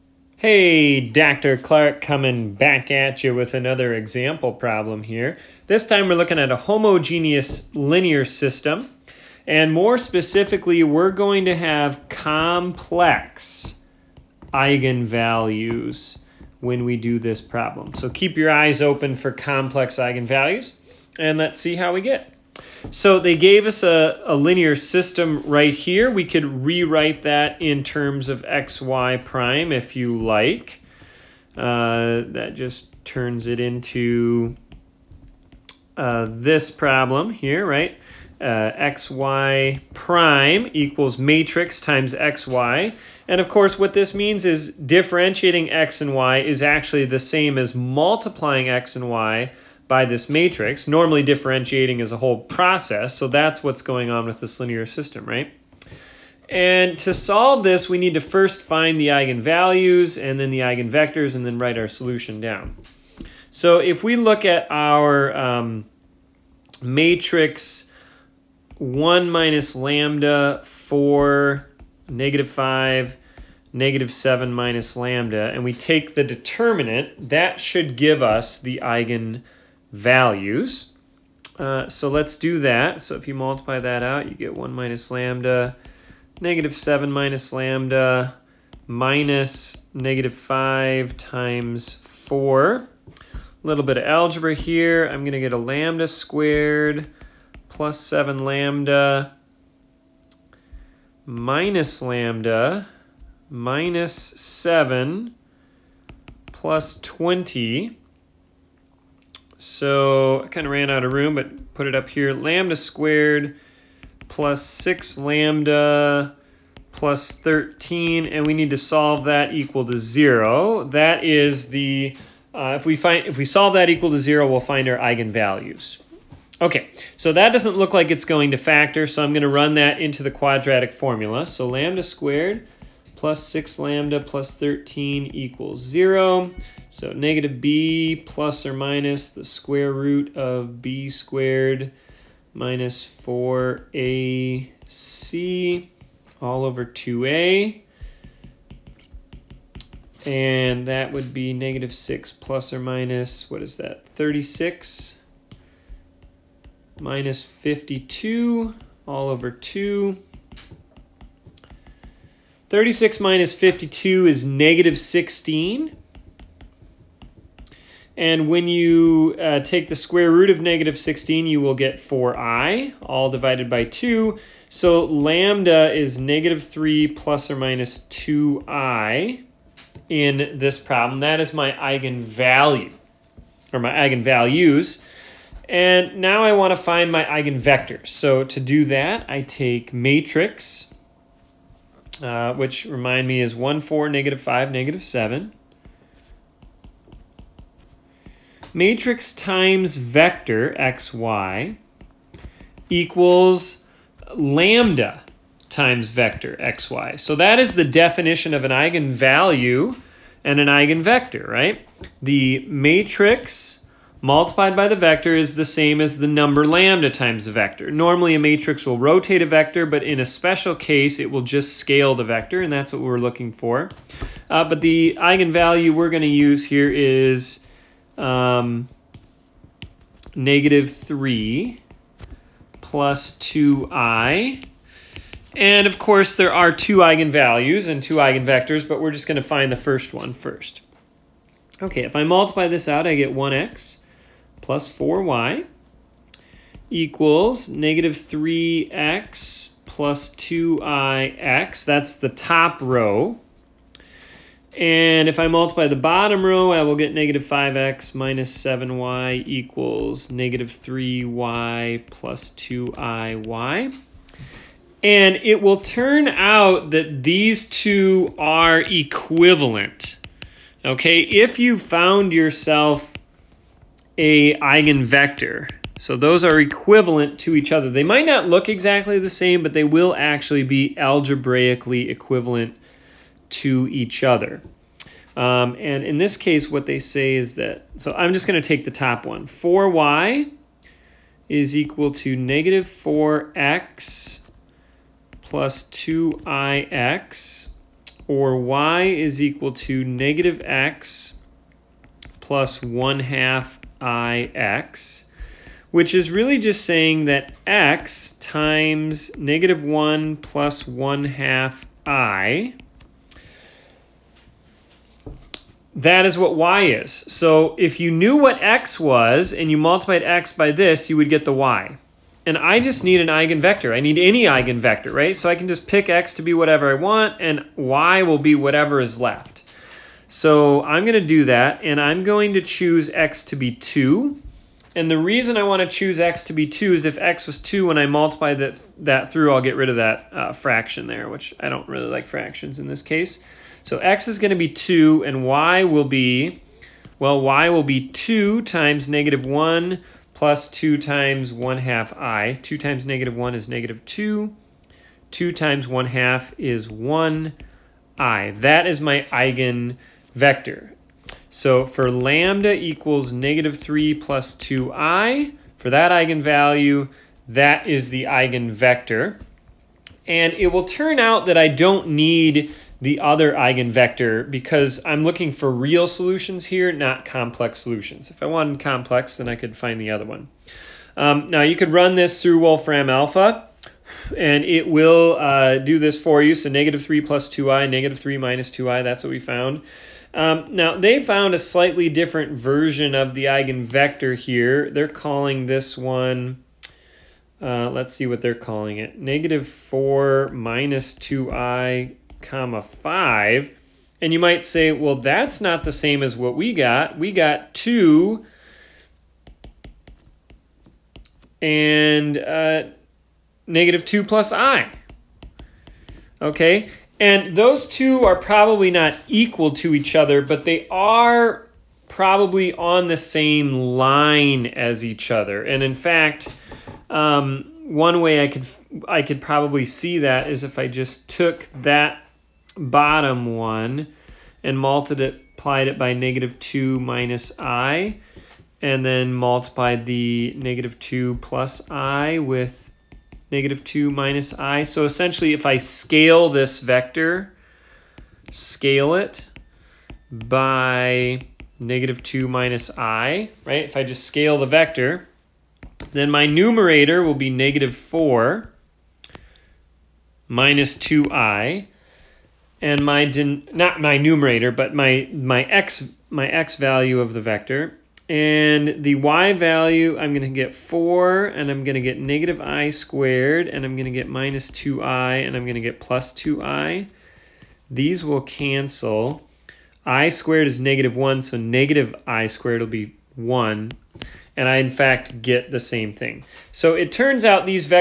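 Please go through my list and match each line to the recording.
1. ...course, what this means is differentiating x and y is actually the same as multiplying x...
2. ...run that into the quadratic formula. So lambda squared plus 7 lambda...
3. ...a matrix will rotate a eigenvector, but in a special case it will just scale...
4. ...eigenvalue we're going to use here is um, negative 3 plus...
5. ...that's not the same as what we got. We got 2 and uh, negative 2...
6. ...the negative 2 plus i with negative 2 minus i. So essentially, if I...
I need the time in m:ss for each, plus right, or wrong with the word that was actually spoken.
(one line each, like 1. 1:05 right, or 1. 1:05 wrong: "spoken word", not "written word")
1. 0:43 right
2. 2:09 wrong: "6", not "7"
3. 3:38 wrong: "vector", not "eigenvector"
4. 3:45 right
5. 6:45 right
6. 7:20 right.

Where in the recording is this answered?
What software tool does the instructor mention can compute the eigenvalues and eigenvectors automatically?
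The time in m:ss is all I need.
6:22.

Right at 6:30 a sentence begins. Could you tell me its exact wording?
Um, now, they found a slightly different version of the eigenvector here.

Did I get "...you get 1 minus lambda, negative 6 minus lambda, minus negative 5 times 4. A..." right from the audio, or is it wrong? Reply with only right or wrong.
wrong.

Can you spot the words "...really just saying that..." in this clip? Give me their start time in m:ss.
5:06.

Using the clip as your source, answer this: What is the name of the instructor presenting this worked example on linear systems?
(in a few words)
Dr. Clark.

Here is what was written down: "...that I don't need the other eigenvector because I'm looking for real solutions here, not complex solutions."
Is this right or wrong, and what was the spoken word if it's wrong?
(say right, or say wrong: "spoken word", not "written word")
right.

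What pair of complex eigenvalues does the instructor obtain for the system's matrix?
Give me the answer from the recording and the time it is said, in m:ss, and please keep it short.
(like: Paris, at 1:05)
-3 ± 2i, at 2:56.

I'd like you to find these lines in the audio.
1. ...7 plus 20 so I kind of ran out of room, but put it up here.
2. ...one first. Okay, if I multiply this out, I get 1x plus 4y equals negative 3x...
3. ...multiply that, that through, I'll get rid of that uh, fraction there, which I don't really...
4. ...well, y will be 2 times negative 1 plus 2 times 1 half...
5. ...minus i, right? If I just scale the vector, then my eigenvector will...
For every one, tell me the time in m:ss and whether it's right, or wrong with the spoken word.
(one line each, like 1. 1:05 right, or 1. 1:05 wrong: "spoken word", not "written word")
1. 1:44 right
2. 4:00 right
3. 5:38 right
4. 5:47 right
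5. 7:32 wrong: "numerator", not "eigenvector".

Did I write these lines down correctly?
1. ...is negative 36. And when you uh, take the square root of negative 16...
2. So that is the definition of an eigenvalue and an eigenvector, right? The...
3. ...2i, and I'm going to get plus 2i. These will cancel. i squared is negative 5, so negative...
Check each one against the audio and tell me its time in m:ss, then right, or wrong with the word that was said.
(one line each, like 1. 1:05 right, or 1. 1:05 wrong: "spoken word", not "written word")
1. 2:44 wrong: "16", not "36"
2. 3:27 right
3. 7:54 wrong: "1", not "5".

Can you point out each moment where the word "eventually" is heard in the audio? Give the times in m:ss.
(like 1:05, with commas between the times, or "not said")
not said.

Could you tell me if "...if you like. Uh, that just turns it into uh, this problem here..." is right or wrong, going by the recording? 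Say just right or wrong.
right.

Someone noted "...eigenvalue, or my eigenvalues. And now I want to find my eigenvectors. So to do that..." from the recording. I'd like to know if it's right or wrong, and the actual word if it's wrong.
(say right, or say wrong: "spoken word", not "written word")
right.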